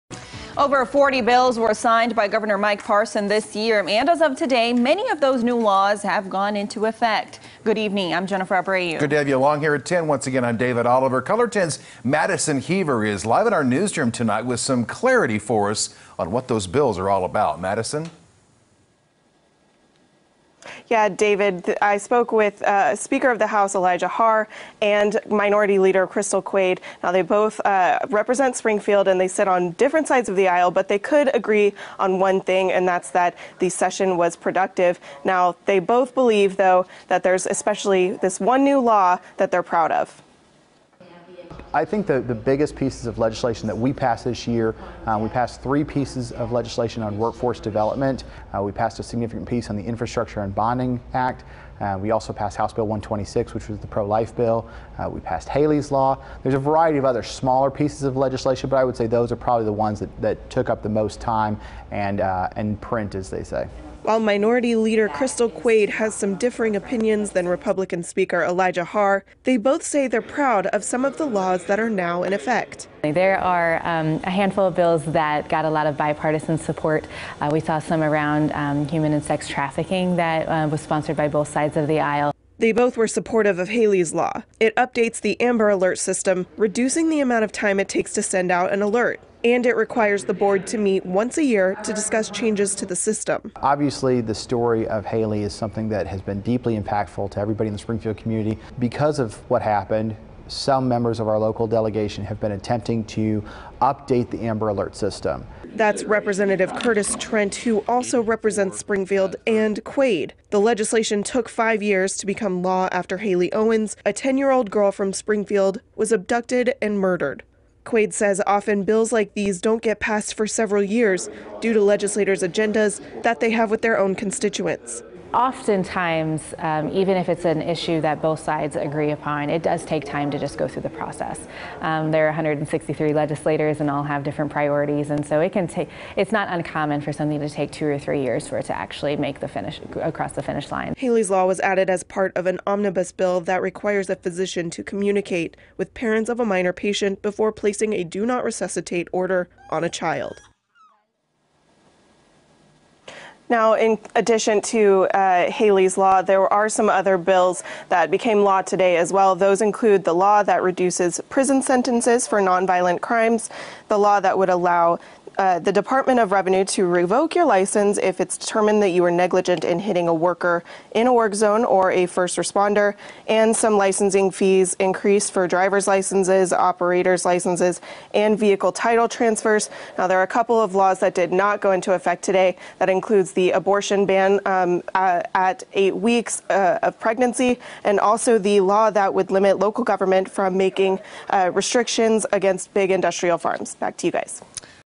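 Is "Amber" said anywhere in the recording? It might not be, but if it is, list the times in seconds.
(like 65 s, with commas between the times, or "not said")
85 s, 104 s.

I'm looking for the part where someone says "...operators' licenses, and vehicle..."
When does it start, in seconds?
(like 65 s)
176 s.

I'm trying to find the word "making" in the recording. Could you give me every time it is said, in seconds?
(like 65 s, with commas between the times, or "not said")
190 s.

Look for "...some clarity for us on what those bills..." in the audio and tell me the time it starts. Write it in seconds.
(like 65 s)
14 s.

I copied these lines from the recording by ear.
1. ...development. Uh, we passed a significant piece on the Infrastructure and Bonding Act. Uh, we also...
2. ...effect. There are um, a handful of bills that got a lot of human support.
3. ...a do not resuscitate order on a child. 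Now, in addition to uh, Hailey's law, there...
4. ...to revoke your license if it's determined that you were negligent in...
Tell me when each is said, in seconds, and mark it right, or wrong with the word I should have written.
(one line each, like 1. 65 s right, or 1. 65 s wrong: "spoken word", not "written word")
1. 47 s right
2. 72 s wrong: "bipartisan", not "human"
3. 147 s right
4. 166 s right.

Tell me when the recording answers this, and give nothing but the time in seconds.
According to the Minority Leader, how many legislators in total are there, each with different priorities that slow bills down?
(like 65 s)
132 s.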